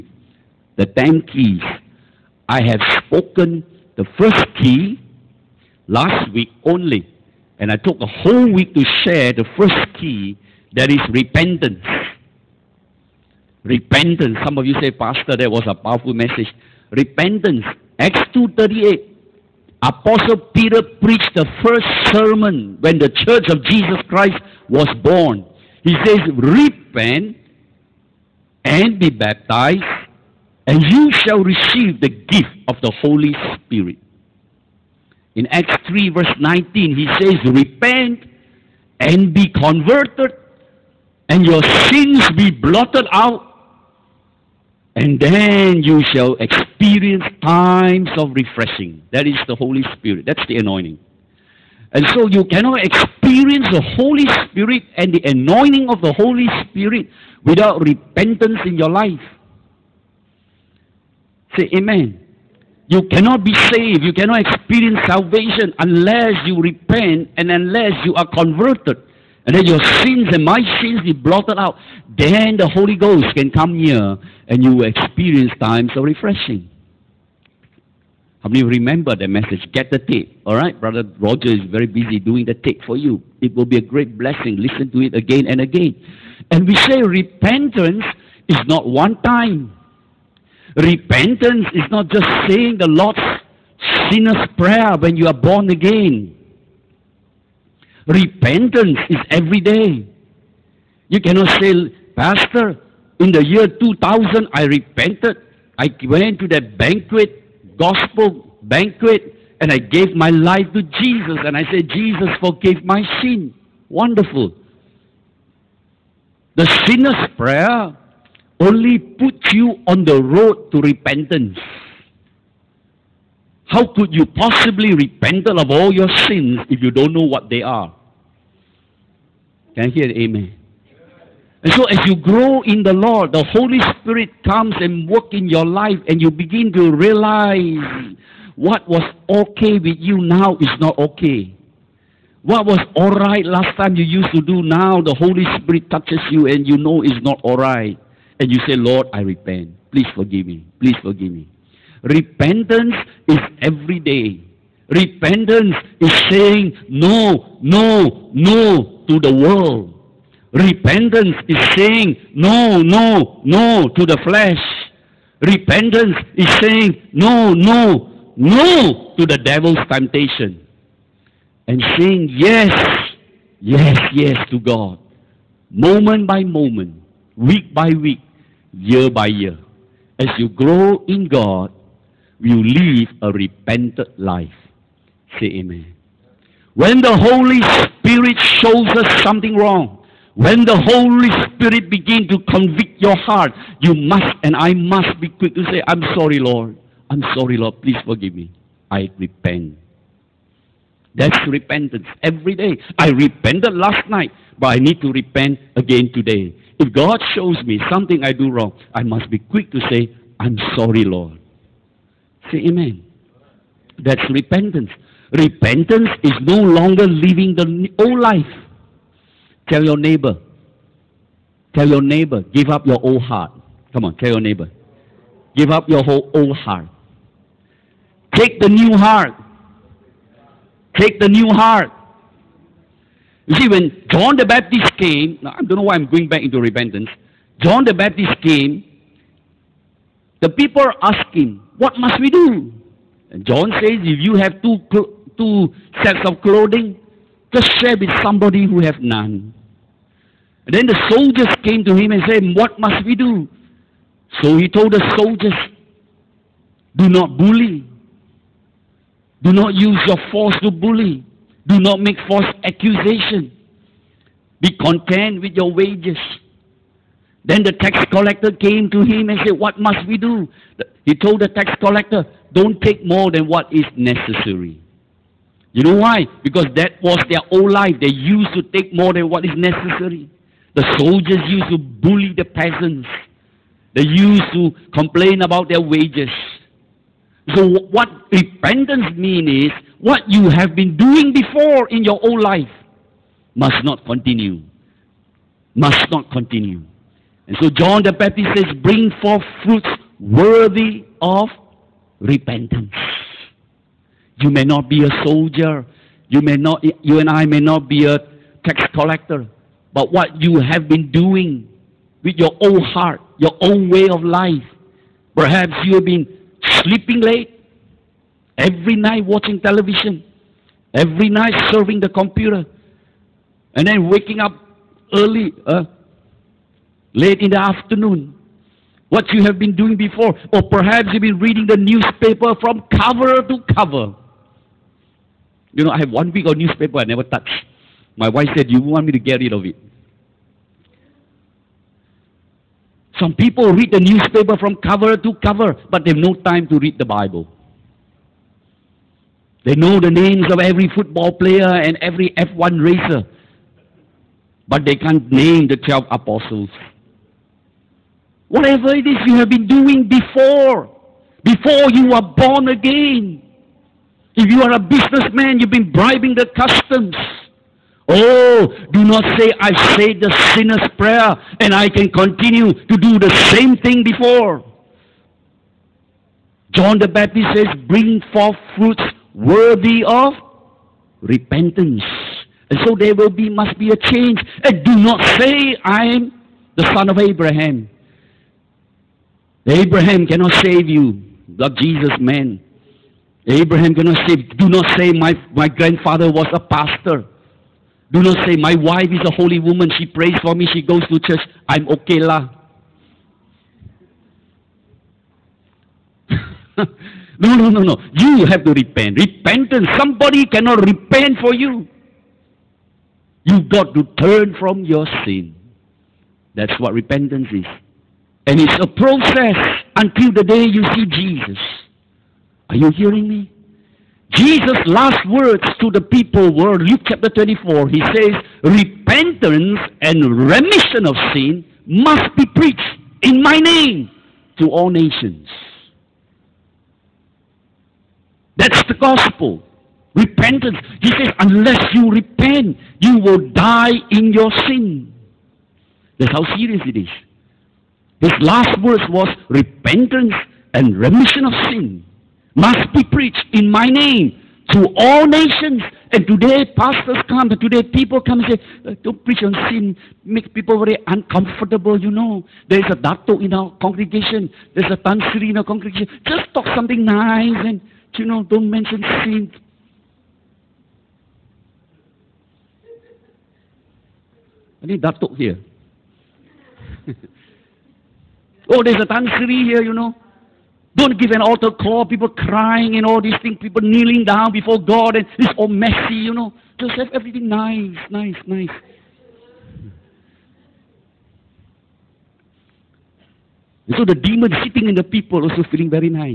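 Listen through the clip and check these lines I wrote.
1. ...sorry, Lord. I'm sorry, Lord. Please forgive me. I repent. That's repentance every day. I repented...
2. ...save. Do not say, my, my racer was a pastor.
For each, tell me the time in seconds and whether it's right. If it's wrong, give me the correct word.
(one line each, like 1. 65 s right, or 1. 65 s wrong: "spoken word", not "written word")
1. 196 s right
2. 394 s wrong: "grandfather", not "racer".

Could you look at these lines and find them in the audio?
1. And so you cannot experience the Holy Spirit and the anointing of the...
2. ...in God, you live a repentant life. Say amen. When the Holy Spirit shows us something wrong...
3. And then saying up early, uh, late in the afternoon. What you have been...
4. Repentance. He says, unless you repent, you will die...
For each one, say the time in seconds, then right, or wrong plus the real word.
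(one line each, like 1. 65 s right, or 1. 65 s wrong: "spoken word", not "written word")
1. 51 s right
2. 181 s right
3. 323 s wrong: "waking", not "saying"
4. 440 s right.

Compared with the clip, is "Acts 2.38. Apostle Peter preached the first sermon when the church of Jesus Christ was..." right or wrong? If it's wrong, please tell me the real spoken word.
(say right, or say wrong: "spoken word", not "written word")
right.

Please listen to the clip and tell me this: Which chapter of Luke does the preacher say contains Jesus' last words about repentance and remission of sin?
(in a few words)
Chapter 24.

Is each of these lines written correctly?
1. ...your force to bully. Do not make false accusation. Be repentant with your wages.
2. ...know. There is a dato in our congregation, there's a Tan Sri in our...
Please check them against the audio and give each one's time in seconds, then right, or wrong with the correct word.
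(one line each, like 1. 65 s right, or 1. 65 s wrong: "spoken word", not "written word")
1. 260 s wrong: "content", not "repentant"
2. 462 s right.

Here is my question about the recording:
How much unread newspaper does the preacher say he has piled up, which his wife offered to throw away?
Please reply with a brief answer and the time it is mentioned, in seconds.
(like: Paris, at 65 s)
One week, at 336 s.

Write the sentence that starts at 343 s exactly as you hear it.
Some people read the newspaper from cover to cover, but they have no time to read the Bible.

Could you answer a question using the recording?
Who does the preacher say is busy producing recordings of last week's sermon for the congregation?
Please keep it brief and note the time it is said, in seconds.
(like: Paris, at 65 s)
Brother Roger, at 80 s.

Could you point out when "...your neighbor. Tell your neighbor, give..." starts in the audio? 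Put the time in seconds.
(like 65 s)
219 s.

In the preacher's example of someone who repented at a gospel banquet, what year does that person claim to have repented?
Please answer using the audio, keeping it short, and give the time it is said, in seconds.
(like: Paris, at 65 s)
2000, at 103 s.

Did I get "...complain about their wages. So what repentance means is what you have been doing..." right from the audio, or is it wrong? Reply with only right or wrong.
right.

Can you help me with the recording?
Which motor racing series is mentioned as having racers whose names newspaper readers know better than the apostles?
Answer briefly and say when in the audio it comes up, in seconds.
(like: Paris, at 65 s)
F1, at 352 s.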